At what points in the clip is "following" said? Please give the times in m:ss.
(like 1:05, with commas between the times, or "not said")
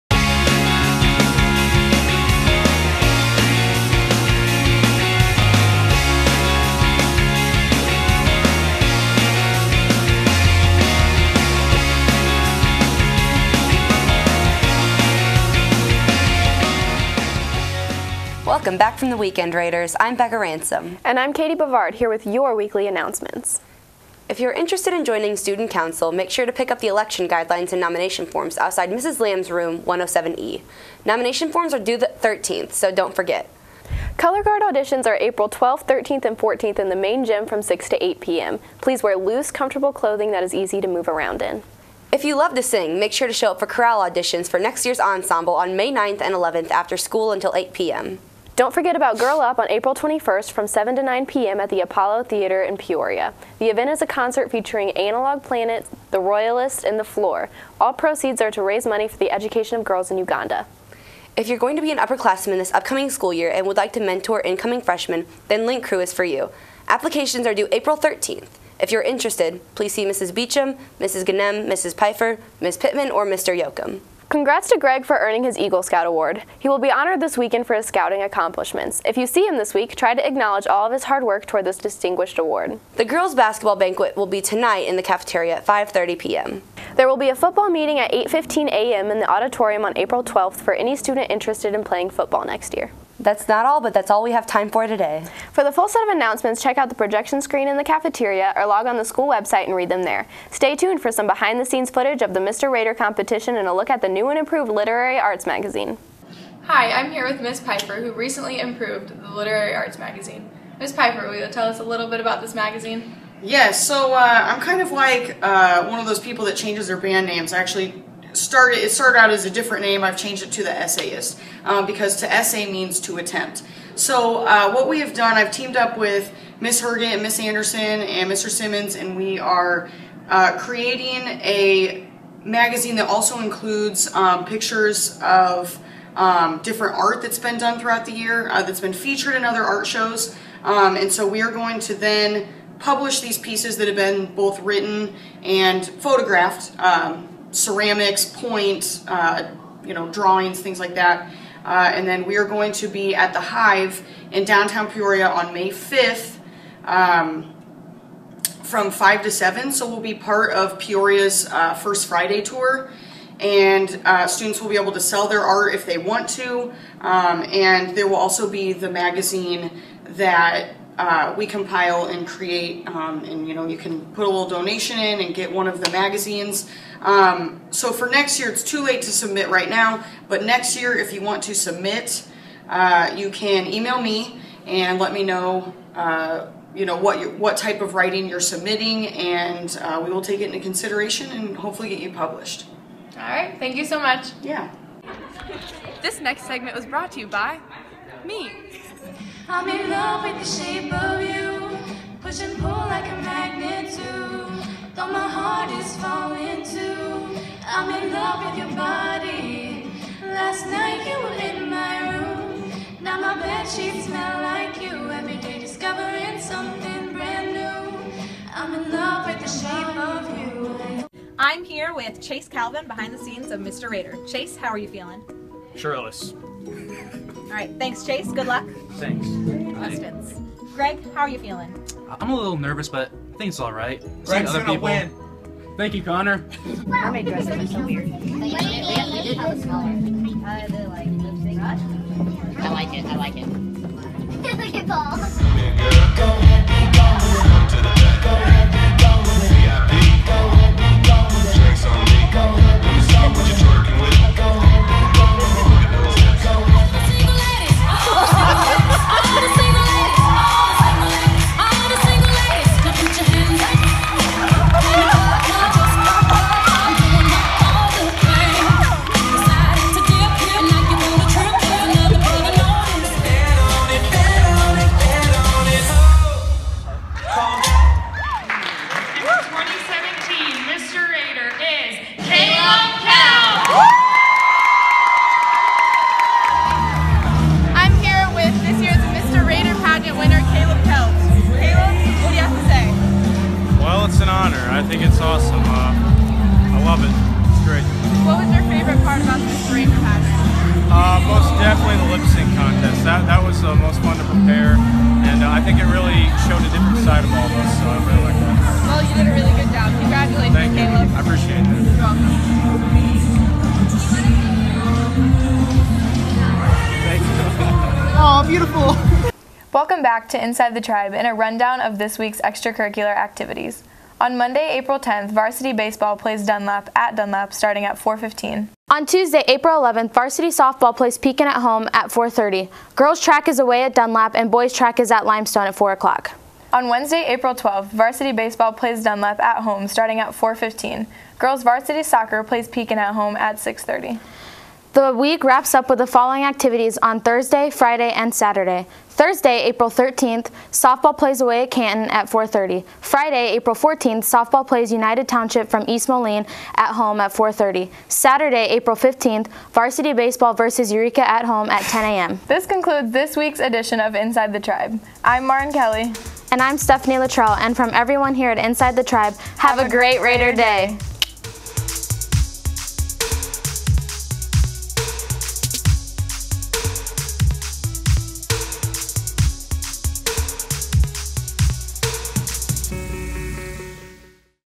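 5:46.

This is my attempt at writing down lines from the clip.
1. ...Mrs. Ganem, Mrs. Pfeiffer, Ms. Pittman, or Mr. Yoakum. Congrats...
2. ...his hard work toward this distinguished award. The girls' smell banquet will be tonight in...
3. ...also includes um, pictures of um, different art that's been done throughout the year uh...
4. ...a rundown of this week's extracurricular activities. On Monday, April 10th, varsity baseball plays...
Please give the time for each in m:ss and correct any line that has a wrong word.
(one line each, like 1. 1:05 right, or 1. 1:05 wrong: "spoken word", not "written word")
1. 1:10 right
2. 1:20 wrong: "basketball", not "smell"
3. 2:13 right
4. 5:21 right.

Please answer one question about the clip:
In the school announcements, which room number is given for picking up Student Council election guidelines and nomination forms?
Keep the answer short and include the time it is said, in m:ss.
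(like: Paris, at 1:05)
107E, at 0:29.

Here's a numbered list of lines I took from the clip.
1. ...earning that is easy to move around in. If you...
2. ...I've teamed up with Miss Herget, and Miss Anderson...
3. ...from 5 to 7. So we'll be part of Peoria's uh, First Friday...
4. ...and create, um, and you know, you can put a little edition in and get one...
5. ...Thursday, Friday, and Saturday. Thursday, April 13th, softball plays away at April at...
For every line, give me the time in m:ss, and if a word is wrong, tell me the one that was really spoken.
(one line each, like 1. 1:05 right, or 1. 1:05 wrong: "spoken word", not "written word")
1. 0:39 wrong: "clothing", not "earning"
2. 2:05 right
3. 2:38 right
4. 2:52 wrong: "donation", not "edition"
5. 5:47 wrong: "Canton", not "April".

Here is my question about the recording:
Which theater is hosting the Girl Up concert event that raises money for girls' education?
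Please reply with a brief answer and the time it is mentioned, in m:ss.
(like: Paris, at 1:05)
Apollo Theater, at 0:51.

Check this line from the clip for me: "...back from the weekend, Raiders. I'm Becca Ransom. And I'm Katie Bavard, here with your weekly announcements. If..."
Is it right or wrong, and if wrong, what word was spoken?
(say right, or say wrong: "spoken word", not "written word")
right.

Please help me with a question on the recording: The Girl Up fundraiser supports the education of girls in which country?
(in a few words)
Uganda.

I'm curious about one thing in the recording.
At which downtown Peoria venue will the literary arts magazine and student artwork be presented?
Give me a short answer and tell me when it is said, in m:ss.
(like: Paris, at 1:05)
The Hive, at 2:33.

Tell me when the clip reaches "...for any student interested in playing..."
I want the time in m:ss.
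1:30.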